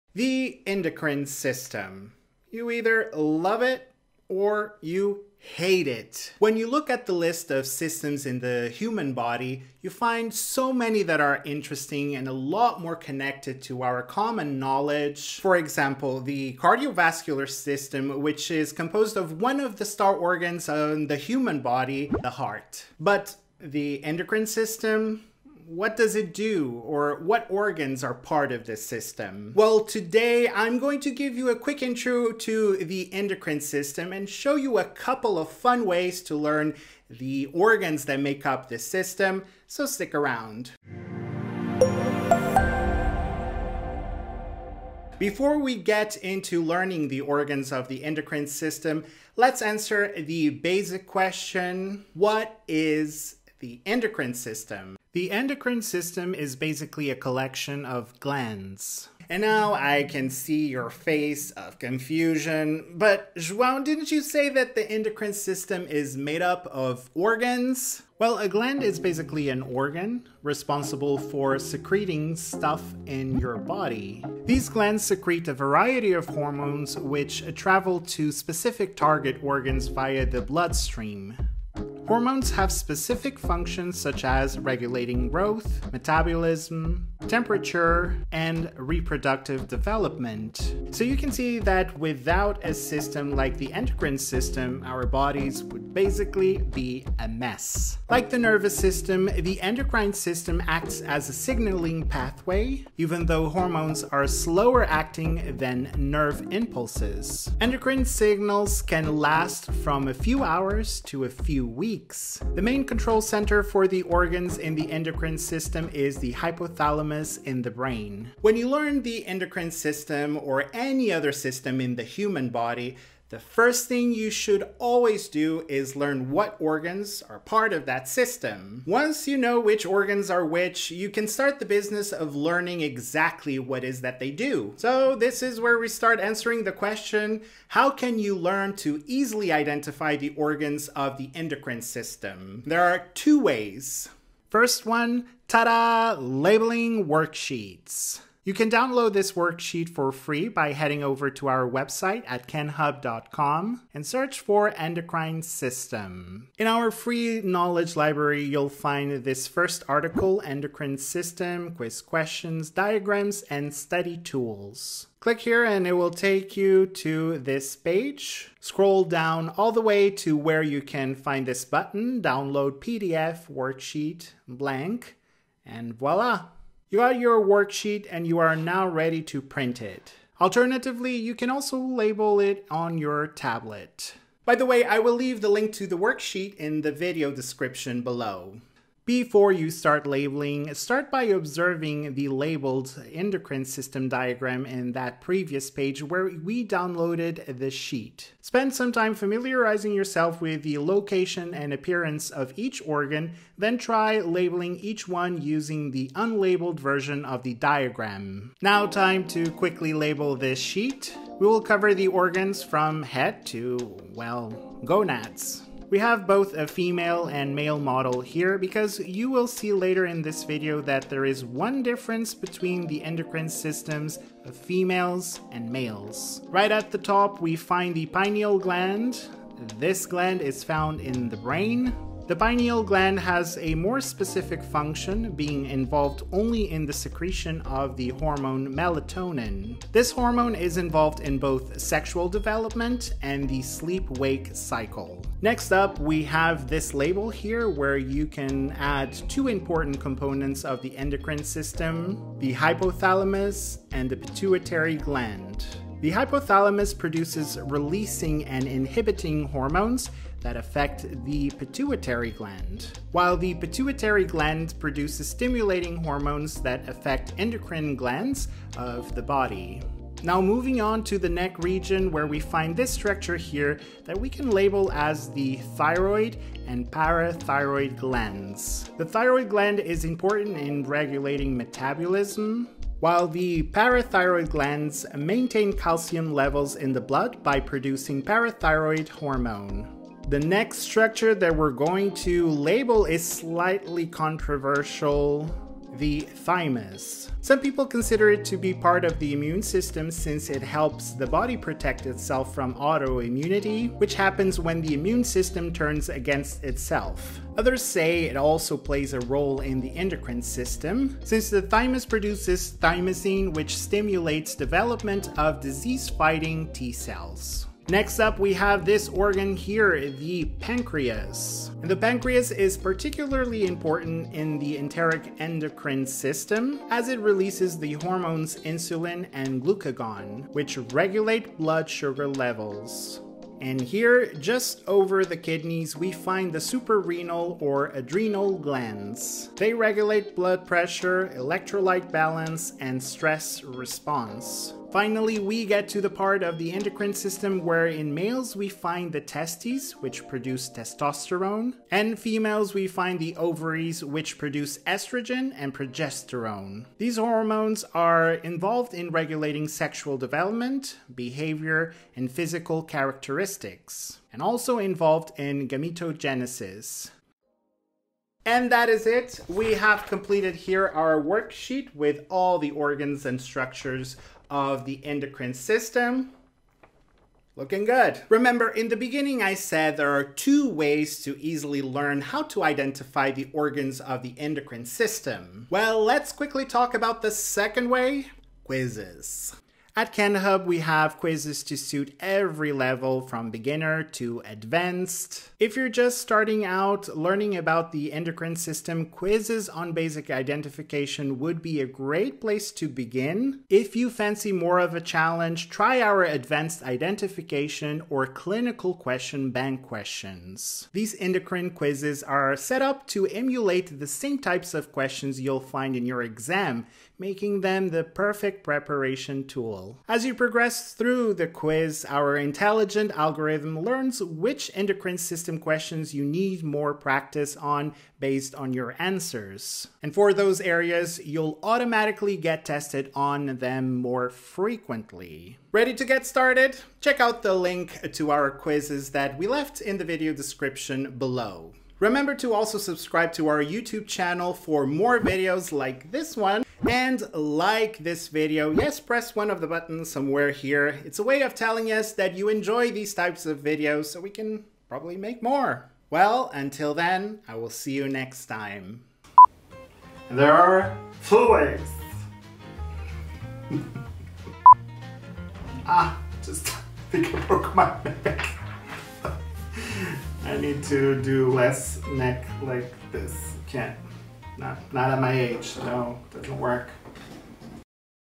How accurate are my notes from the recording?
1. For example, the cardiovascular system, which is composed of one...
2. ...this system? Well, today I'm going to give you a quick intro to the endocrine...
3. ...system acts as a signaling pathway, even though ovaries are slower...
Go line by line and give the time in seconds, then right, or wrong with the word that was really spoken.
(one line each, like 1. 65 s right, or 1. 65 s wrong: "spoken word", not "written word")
1. 15 s right
2. 28 s right
3. 100 s wrong: "hormones", not "ovaries".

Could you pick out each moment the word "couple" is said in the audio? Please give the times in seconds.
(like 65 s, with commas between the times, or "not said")
34 s.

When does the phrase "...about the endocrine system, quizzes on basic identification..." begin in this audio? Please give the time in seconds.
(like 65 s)
397 s.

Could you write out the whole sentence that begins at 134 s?
So this is where we start answering the question, how can you learn to easily identify the organs of the endocrine system?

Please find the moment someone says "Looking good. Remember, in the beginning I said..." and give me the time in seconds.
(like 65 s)
377 s.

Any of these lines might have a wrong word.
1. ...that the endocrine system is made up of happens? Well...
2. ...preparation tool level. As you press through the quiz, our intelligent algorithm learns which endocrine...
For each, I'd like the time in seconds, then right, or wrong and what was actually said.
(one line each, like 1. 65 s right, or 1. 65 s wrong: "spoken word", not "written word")
1. 64 s wrong: "organs", not "happens"
2. 418 s wrong: "progress", not "press".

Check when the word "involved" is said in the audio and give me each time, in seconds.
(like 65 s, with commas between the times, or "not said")
235 s, 240 s, 358 s, 364 s.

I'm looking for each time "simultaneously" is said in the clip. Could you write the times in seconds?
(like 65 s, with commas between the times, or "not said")
not said.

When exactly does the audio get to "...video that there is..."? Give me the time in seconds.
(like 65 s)
220 s.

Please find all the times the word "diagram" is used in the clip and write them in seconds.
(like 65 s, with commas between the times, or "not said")
162 s, 194 s, 207 s.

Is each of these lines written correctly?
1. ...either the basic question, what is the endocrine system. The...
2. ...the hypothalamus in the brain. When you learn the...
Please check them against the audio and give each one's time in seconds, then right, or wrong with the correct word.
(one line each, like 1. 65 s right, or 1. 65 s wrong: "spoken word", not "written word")
1. 49 s wrong: "answer", not "either"
2. 116 s right.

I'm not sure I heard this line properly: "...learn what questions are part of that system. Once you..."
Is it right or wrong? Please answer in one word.
wrong.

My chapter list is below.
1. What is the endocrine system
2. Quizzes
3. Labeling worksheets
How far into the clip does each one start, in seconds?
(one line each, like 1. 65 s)
1. 55 s
2. 387 s
3. 145 s.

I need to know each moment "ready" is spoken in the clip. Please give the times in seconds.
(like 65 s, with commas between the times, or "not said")
178 s, 435 s.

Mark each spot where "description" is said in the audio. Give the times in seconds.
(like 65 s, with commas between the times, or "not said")
187 s, 440 s.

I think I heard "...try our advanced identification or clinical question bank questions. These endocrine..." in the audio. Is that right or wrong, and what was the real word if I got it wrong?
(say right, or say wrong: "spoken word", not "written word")
right.